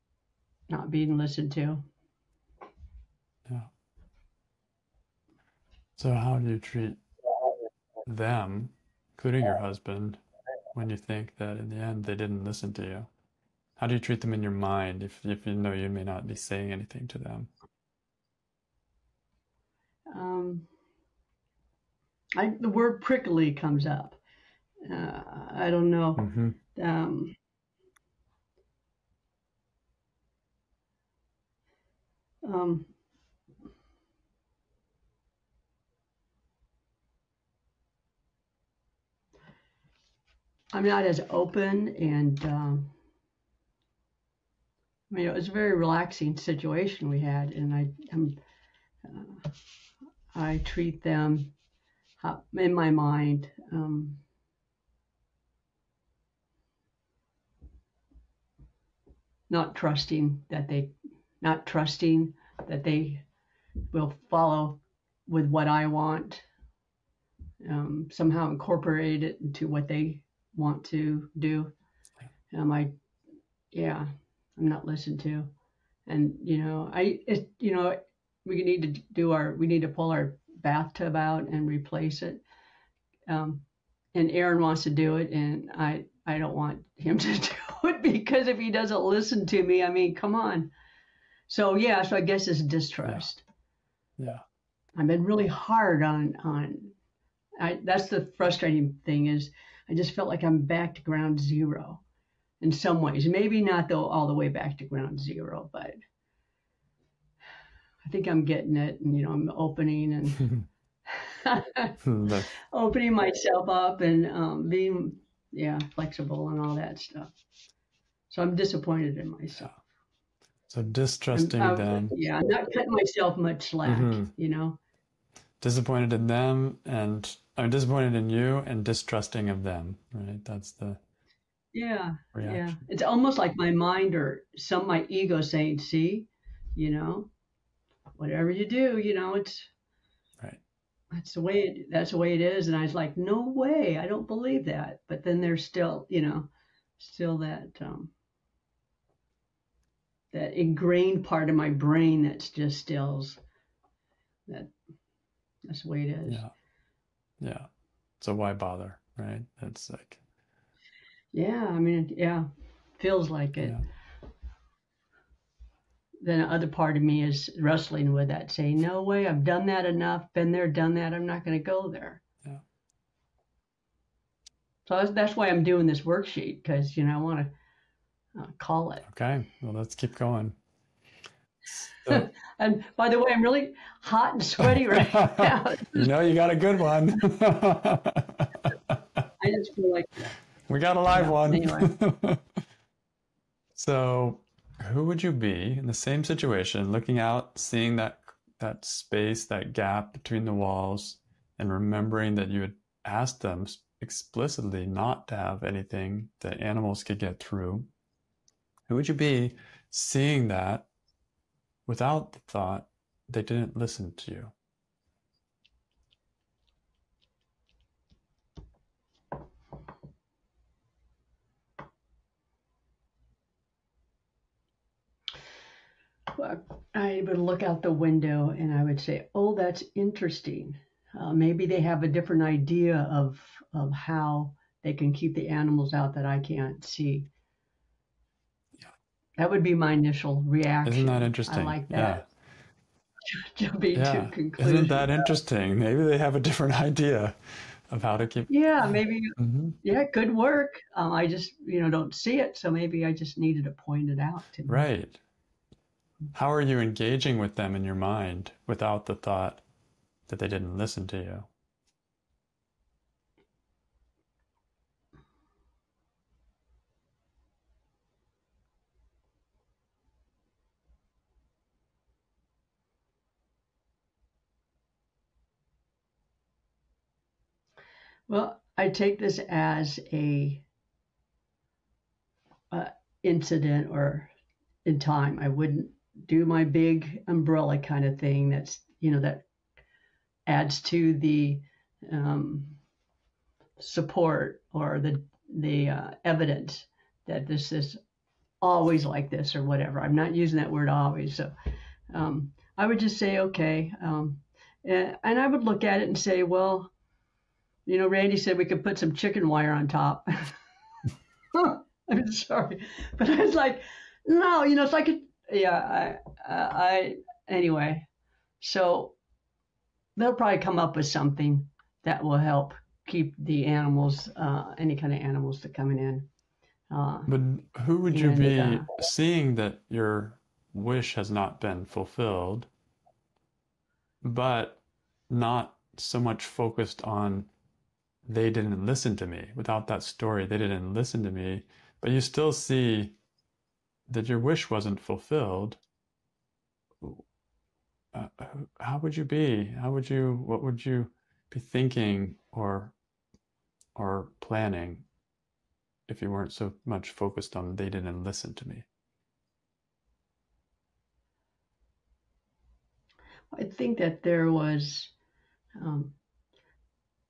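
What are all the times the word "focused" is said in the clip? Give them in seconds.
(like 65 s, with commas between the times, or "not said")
336 s, 357 s.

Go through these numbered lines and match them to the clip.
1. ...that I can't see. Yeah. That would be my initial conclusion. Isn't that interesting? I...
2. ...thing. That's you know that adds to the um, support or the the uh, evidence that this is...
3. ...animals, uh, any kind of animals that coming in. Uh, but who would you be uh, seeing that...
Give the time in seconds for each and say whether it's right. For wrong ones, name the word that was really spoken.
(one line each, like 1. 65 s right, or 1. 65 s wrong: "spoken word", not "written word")
1. 236 s wrong: "reaction", not "conclusion"
2. 288 s right
3. 323 s right.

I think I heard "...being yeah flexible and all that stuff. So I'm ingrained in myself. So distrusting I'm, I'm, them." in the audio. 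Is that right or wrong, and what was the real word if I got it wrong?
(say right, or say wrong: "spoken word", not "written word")
wrong: "disappointed", not "ingrained".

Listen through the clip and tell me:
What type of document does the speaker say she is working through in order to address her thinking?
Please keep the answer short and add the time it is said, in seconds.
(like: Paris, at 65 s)
Worksheet, at 176 s.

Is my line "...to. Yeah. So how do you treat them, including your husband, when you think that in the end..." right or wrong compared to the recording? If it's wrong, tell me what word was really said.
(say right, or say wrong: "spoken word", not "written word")
right.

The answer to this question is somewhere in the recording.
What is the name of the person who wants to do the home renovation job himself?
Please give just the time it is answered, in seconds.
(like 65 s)
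84 s.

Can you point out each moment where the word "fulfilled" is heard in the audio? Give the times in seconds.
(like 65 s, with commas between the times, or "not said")
331 s, 344 s.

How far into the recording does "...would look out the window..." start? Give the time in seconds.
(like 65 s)
227 s.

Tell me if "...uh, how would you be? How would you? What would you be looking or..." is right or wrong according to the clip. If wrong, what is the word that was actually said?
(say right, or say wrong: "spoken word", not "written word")
wrong: "thinking", not "looking".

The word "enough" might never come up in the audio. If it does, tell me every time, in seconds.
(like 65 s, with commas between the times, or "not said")
169 s.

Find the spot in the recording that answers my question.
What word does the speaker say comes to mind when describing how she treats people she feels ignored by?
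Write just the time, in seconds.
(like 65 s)
23 s.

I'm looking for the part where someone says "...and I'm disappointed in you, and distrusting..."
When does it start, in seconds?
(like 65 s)
126 s.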